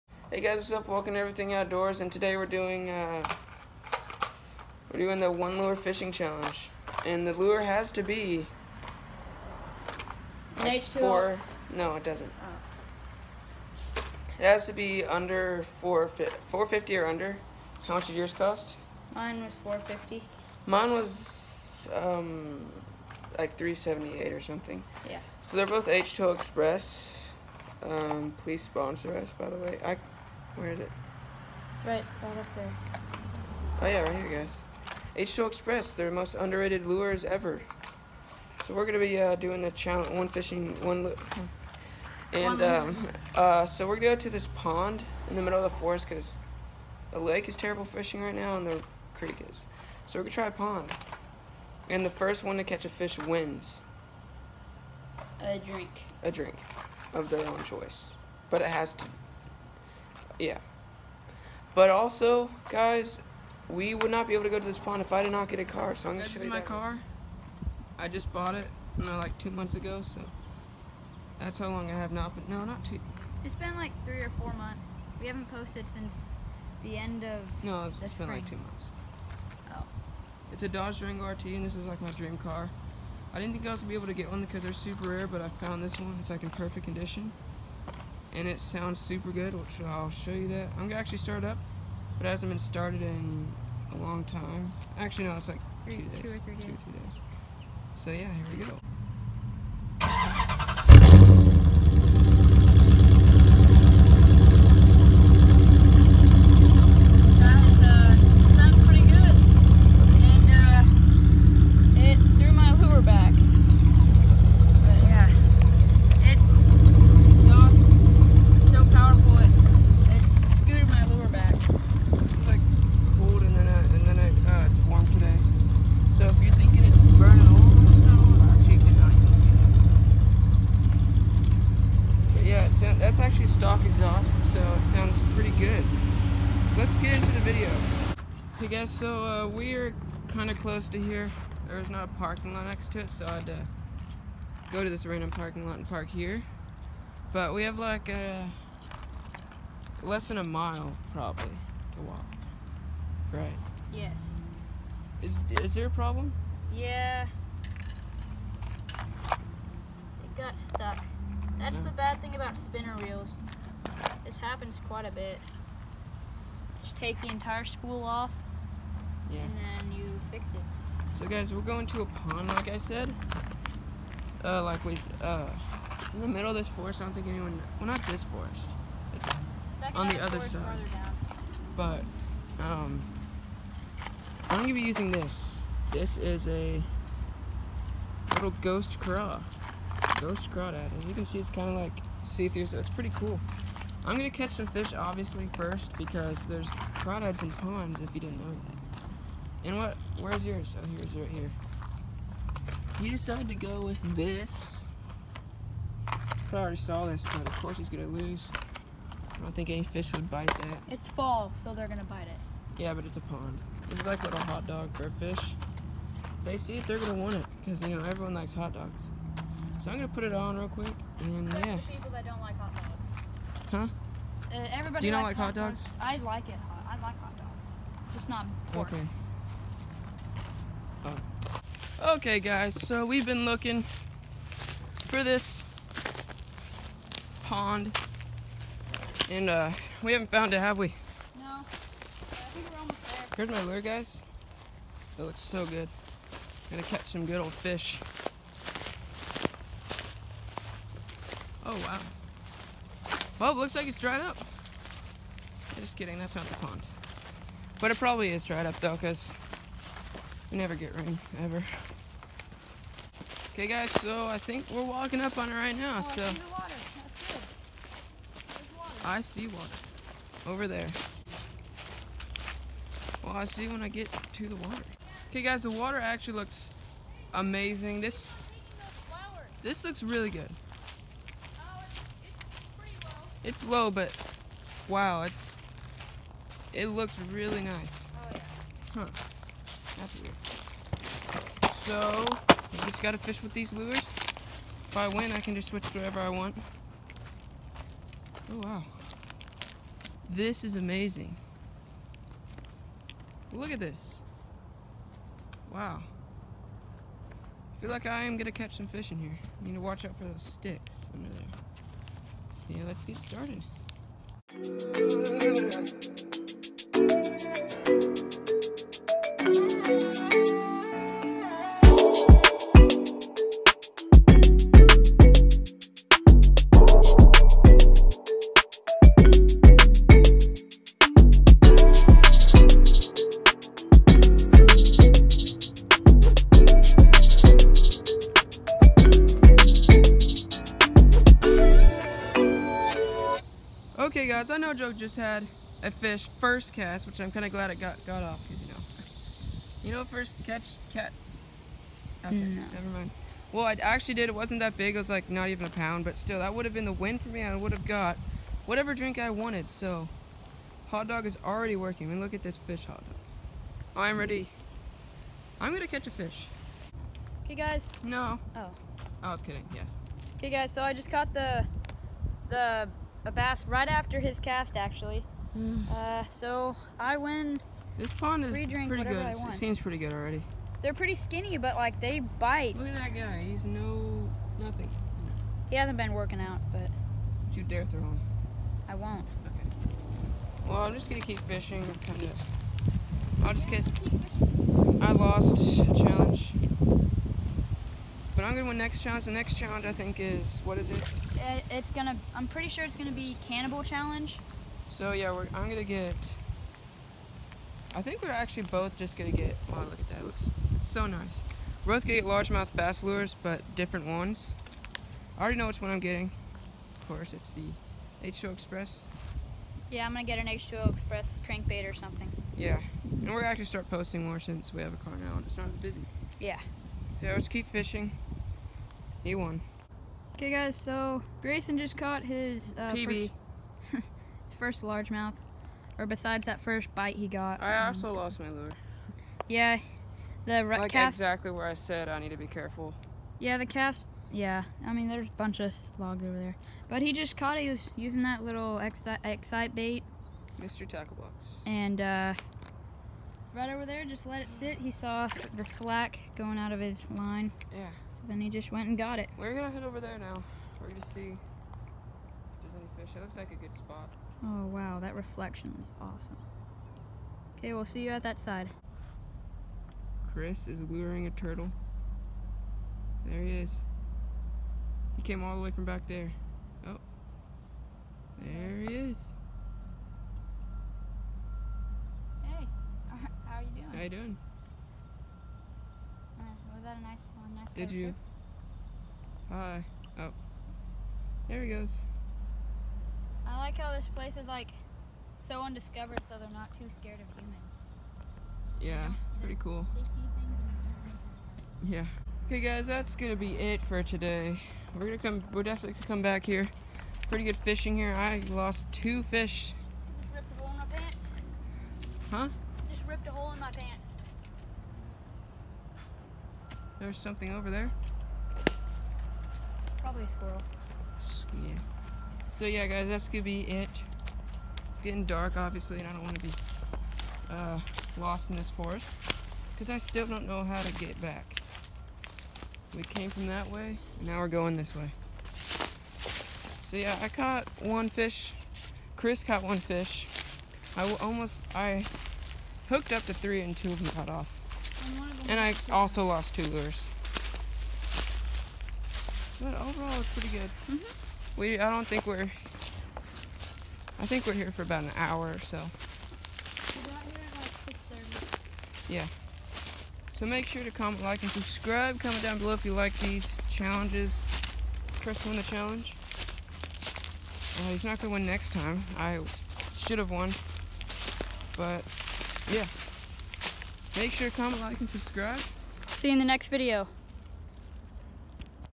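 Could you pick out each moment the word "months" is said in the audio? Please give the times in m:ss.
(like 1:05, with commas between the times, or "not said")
1:09, 1:14, 1:18.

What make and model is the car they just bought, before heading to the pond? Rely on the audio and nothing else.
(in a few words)
Dodge Durango RT.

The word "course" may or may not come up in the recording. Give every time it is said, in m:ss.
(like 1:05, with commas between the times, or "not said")
3:27, 6:57.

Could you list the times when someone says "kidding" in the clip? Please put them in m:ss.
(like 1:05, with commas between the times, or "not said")
4:15, 6:09.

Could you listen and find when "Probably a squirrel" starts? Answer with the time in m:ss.
8:40.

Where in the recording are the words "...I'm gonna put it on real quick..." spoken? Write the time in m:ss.
3:39.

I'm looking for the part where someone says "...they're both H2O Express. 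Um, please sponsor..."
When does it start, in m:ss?
0:25.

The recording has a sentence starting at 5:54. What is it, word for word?
It was like not even a pound, but still, that would have been the win for me.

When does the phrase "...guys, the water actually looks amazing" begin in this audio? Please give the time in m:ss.
4:35.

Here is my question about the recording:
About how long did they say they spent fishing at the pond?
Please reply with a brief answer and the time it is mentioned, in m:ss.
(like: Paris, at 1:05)
About an hour, at 9:14.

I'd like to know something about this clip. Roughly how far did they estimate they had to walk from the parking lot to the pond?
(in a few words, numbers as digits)
Less than a mile.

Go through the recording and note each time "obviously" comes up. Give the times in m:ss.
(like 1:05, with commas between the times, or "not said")
3:14, 8:45.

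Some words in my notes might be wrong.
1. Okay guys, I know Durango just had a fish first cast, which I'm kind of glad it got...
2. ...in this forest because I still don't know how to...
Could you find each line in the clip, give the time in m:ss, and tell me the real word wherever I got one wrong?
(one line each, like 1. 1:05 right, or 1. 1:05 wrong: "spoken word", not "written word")
1. 5:44 wrong: "Joe", not "Durango"
2. 8:48 right.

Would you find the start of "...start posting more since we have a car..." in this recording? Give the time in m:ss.
7:03.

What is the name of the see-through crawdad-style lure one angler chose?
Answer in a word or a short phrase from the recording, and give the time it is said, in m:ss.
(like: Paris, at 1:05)
Ghost craw, at 3:08.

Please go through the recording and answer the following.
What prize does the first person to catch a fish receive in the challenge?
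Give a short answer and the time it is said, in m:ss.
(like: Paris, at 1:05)
A drink, at 0:56.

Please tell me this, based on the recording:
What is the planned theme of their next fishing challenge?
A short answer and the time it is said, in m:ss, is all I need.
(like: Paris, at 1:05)
Cannibal challenge, at 6:43.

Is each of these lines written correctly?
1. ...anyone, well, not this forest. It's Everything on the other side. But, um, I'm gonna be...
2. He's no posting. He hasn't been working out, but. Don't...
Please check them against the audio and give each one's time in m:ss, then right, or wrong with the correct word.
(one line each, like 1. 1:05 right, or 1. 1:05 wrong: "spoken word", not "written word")
1. 2:57 wrong: "Second", not "Everything"
2. 6:23 wrong: "nothing", not "posting".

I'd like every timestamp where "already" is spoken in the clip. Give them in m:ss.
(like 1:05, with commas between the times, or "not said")
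3:26, 6:01, 6:20, 6:55.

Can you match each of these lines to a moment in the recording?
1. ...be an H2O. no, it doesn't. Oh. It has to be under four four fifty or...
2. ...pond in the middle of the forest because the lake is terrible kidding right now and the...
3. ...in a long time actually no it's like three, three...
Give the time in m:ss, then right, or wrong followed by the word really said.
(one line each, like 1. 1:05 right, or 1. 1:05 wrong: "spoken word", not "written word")
1. 0:08 right
2. 0:44 wrong: "fishing", not "kidding"
3. 1:33 wrong: "two", not "three".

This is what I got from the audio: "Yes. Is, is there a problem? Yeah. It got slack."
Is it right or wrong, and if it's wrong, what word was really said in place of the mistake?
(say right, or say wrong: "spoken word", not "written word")
wrong: "stuck", not "slack".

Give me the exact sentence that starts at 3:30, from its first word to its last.
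It's fall, so they're gonna bite it.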